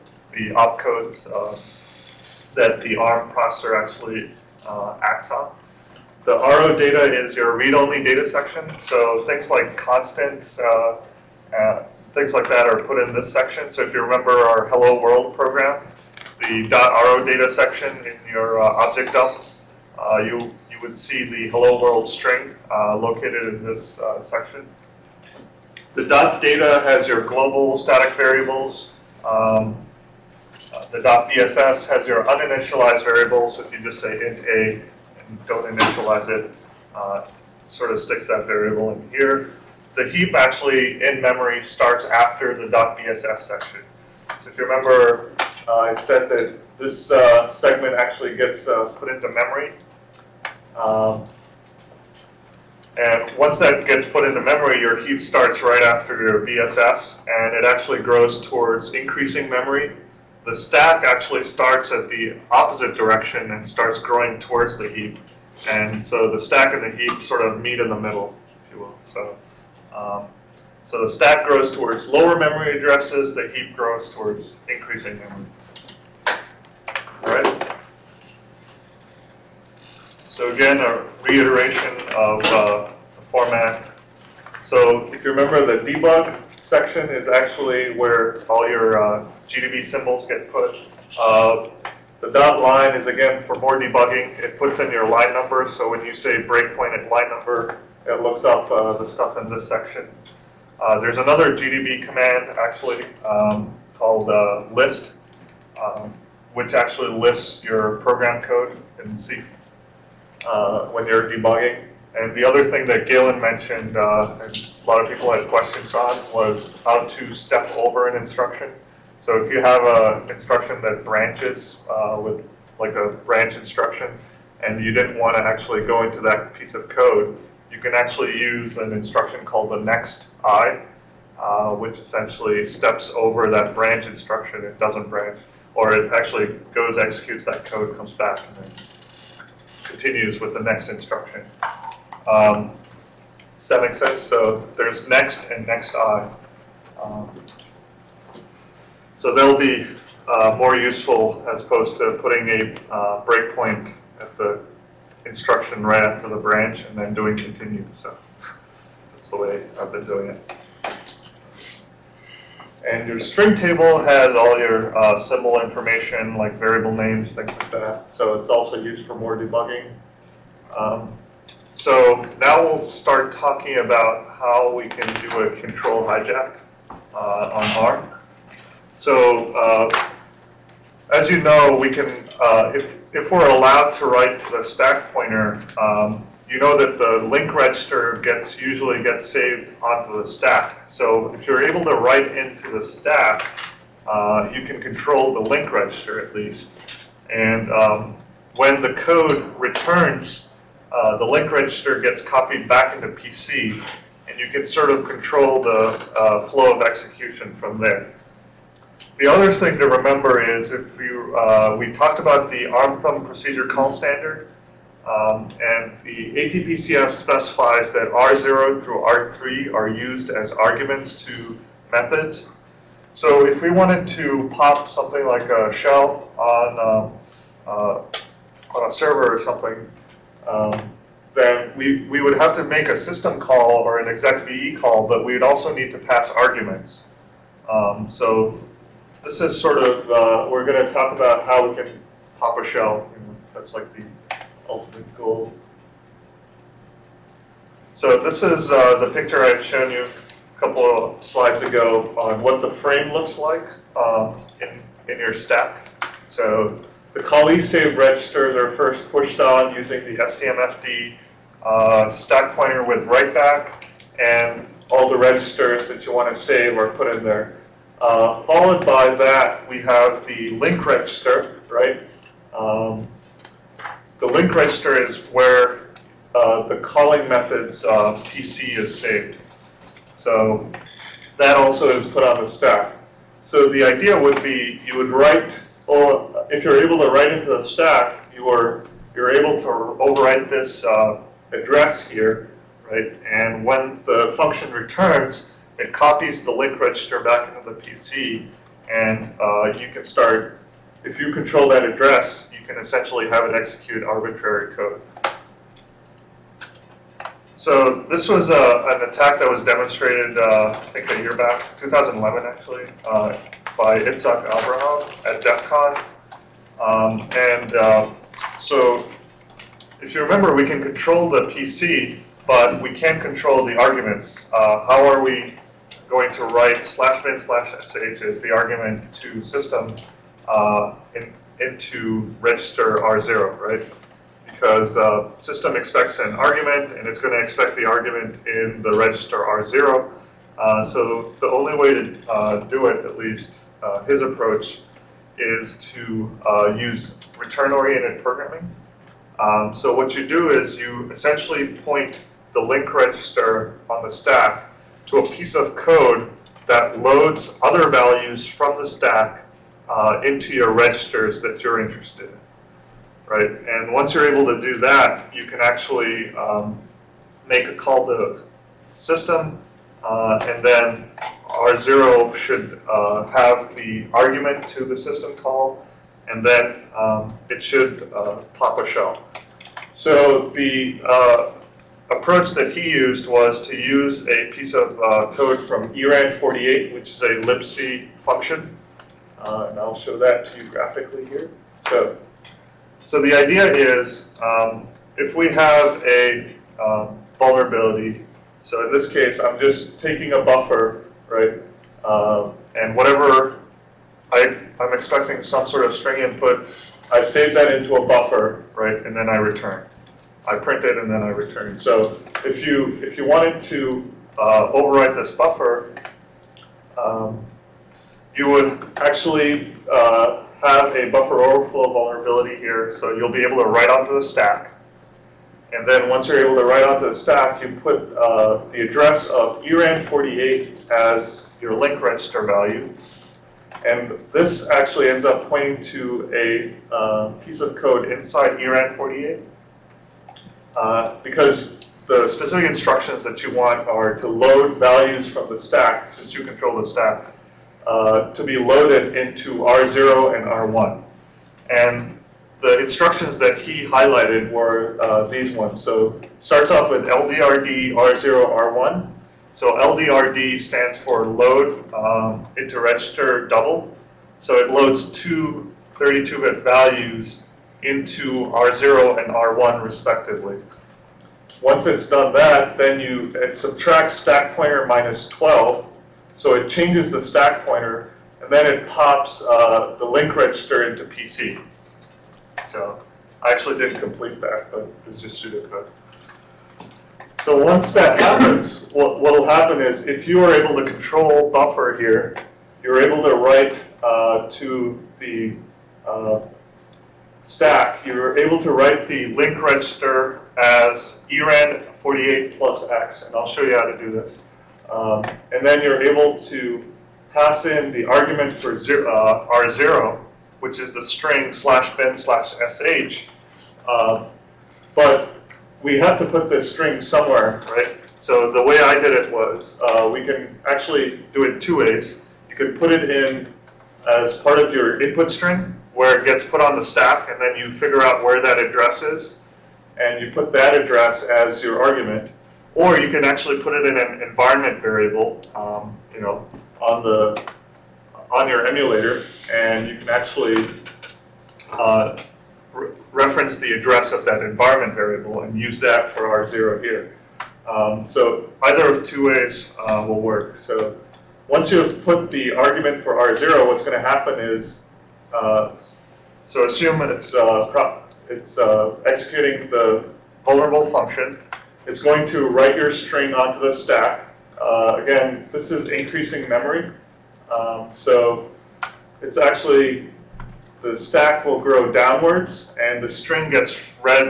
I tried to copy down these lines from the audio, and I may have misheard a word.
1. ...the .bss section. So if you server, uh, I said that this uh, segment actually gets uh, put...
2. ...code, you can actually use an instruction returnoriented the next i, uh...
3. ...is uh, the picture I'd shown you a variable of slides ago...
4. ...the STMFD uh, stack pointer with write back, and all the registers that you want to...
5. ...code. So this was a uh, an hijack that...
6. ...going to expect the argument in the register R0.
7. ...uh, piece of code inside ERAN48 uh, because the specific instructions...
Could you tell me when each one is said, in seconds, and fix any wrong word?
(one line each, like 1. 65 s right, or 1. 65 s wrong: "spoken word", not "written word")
1. 42 s wrong: "remember", not "server"
2. 126 s wrong: "called", not "returnoriented"
3. 248 s wrong: "couple", not "variable"
4. 260 s right
5. 304 s wrong: "attack", not "hijack"
6. 337 s right
7. 436 s right.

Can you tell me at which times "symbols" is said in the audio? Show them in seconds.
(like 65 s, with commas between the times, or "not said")
89 s, 165 s.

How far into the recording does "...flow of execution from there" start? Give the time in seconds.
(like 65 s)
206 s.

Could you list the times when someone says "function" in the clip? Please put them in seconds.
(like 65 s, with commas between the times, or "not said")
294 s, 388 s, 560 s.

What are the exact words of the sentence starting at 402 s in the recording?
Um, and whatever I, I'm expecting some sort of string input, I save that into a buffer, right?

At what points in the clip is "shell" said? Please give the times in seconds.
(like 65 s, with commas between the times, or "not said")
225 s, 242 s, 378 s.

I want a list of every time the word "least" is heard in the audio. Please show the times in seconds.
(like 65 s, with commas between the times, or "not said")
196 s, 343 s.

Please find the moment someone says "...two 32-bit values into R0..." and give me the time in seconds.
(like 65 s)
465 s.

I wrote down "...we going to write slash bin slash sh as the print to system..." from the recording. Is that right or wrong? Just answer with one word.
wrong.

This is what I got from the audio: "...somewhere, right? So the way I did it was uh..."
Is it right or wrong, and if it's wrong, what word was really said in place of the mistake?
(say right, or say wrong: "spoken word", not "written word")
right.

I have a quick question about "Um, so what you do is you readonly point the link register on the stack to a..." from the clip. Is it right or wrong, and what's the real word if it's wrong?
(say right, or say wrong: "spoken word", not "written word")
wrong: "essentially", not "readonly".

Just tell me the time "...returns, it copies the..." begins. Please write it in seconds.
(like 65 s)
294 s.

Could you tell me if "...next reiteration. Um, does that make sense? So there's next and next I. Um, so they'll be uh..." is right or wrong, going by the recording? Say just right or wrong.
wrong.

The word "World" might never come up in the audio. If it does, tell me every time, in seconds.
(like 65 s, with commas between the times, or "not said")
15 s, 21 s.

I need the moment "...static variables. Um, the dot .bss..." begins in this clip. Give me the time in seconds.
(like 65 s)
27 s.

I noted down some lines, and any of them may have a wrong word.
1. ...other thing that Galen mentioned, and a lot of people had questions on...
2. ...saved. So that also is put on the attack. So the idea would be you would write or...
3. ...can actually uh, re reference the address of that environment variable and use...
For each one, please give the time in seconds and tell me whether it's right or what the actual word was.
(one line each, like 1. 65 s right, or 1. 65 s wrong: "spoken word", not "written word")
1. 112 s right
2. 278 s wrong: "stack", not "attack"
3. 539 s right.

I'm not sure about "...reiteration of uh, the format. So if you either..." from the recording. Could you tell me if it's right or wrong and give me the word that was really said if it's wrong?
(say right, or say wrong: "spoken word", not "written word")
wrong: "remember", not "either".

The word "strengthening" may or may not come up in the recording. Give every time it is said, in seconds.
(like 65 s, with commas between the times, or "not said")
not said.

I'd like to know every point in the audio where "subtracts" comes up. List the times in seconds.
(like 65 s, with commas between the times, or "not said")
473 s.